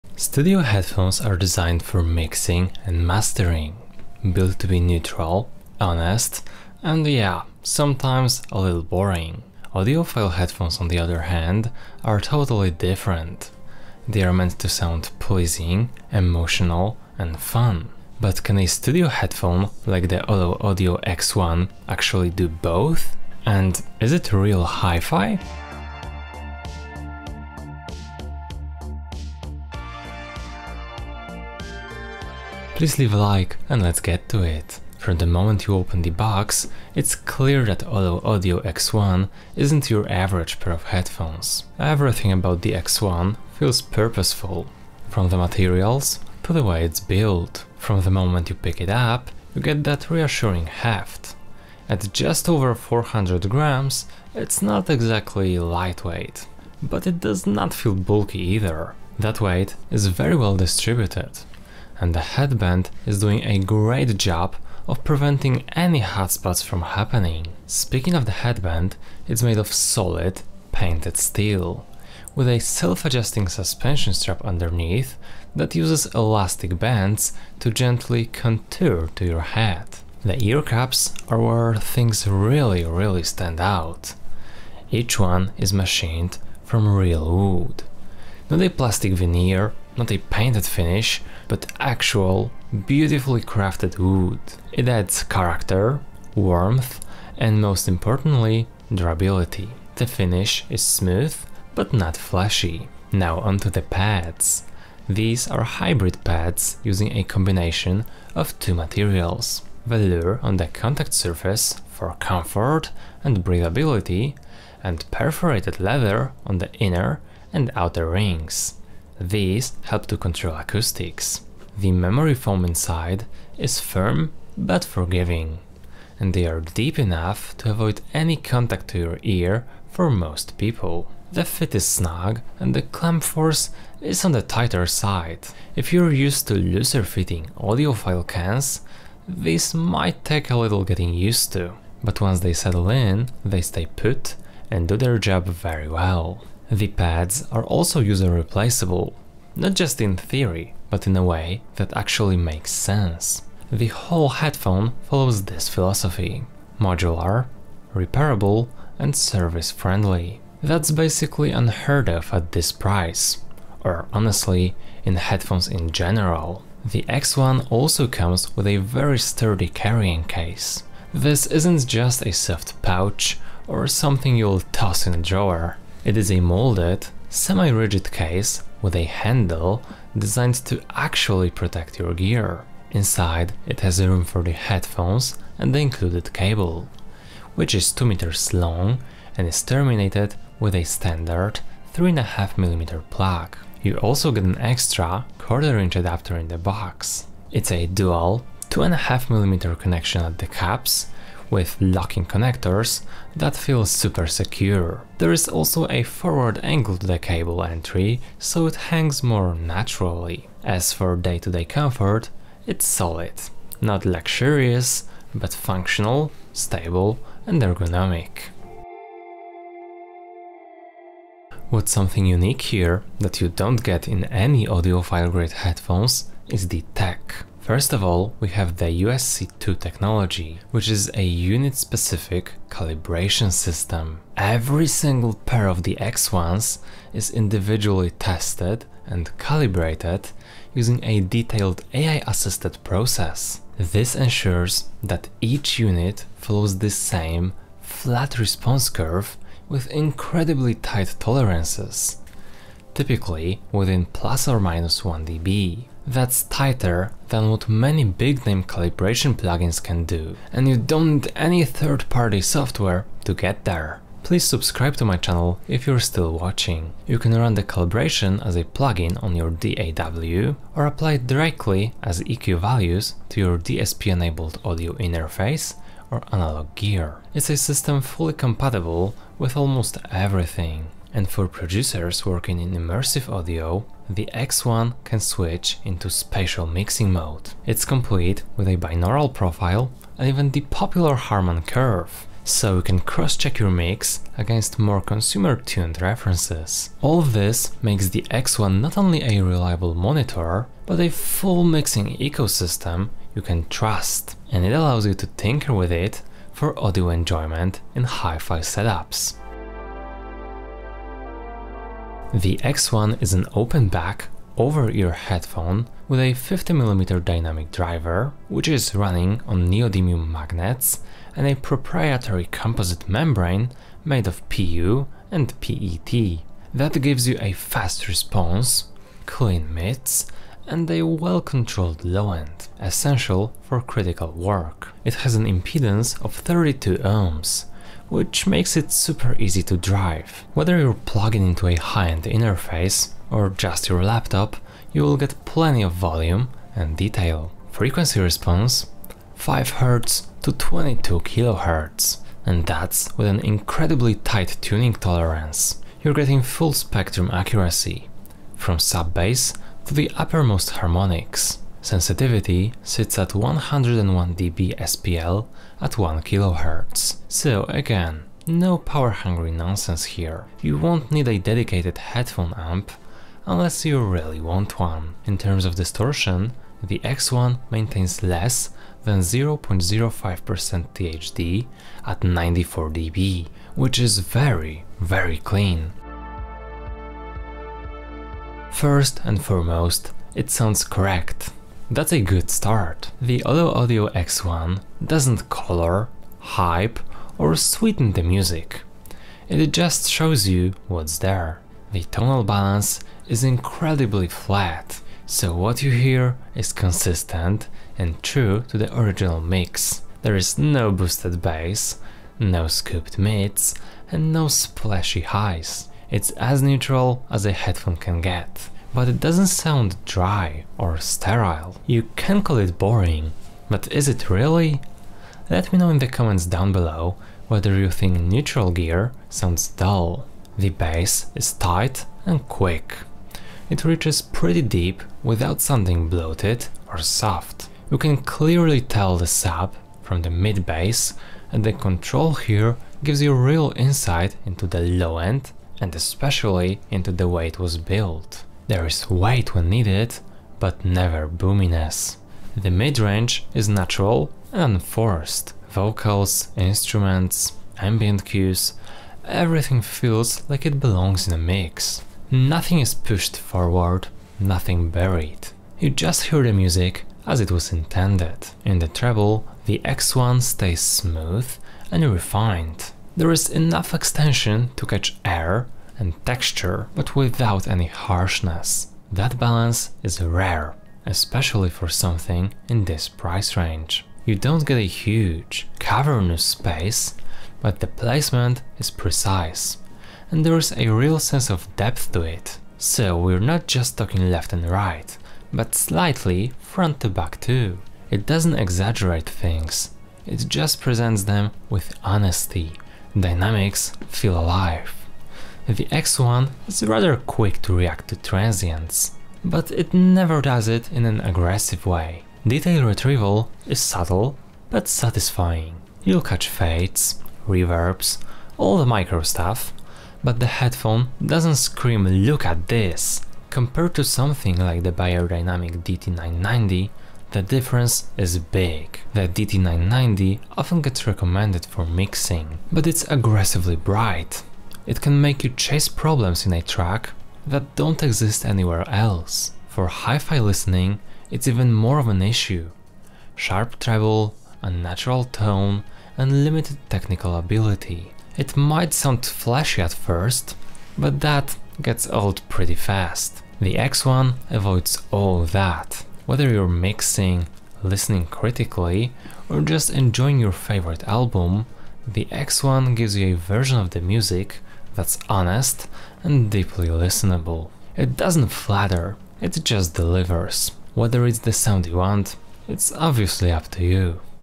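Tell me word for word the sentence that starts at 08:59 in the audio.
For hi-fi listening, it's even more of an issue.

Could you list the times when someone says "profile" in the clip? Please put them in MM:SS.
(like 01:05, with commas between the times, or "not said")
04:49.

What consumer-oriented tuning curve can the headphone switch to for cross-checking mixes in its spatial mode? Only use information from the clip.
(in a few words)
Harman curve.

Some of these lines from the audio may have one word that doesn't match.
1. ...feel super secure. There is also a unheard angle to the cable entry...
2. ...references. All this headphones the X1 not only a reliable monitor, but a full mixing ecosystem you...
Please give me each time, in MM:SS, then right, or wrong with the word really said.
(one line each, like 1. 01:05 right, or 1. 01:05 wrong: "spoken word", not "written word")
1. 03:23 wrong: "forward", not "unheard"
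2. 04:56 wrong: "makes", not "headphones".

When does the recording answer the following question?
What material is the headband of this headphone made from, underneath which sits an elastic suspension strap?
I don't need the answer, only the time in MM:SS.
01:10.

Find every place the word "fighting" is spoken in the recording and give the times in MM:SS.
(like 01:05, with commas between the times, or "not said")
not said.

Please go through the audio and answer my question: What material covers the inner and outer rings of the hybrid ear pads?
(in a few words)
perforated leather.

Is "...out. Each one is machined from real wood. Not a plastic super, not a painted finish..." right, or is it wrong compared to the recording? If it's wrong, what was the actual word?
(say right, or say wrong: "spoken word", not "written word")
wrong: "veneer", not "super".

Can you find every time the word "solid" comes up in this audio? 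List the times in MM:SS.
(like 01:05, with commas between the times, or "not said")
01:09, 03:32.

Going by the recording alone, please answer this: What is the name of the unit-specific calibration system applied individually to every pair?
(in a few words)
USC2.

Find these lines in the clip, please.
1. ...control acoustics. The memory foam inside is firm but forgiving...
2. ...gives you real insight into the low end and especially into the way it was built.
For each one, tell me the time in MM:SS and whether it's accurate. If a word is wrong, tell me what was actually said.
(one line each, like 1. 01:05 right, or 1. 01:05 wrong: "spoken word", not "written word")
1. 02:00 right
2. 07:23 right.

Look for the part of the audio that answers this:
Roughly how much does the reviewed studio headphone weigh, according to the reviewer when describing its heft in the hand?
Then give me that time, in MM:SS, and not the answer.
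00:52.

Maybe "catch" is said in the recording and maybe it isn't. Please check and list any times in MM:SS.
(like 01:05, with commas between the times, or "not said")
07:54, 08:36.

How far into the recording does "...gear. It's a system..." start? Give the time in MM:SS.
04:36.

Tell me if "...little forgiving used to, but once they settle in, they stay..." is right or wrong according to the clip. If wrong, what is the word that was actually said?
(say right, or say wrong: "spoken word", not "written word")
wrong: "getting", not "forgiving".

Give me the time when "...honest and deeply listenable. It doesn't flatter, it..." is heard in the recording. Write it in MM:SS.
09:25.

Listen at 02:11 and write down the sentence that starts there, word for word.
The fit is snug and the clamp force is on the tighter side.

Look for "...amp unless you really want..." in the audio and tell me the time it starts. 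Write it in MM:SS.
06:12.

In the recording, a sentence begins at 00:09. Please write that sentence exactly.
Audiophile headphones, on the other hand, are totally different.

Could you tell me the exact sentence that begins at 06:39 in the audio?
It just shows you what's there.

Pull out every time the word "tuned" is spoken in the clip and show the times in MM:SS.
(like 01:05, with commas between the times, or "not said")
04:55.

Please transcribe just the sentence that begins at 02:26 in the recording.
The pads are also user replaceable, not just in theory, but in a way that actually makes sense.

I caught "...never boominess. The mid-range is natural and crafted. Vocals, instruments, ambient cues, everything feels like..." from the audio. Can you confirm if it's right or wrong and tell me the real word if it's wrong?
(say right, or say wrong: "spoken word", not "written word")
wrong: "forced", not "crafted".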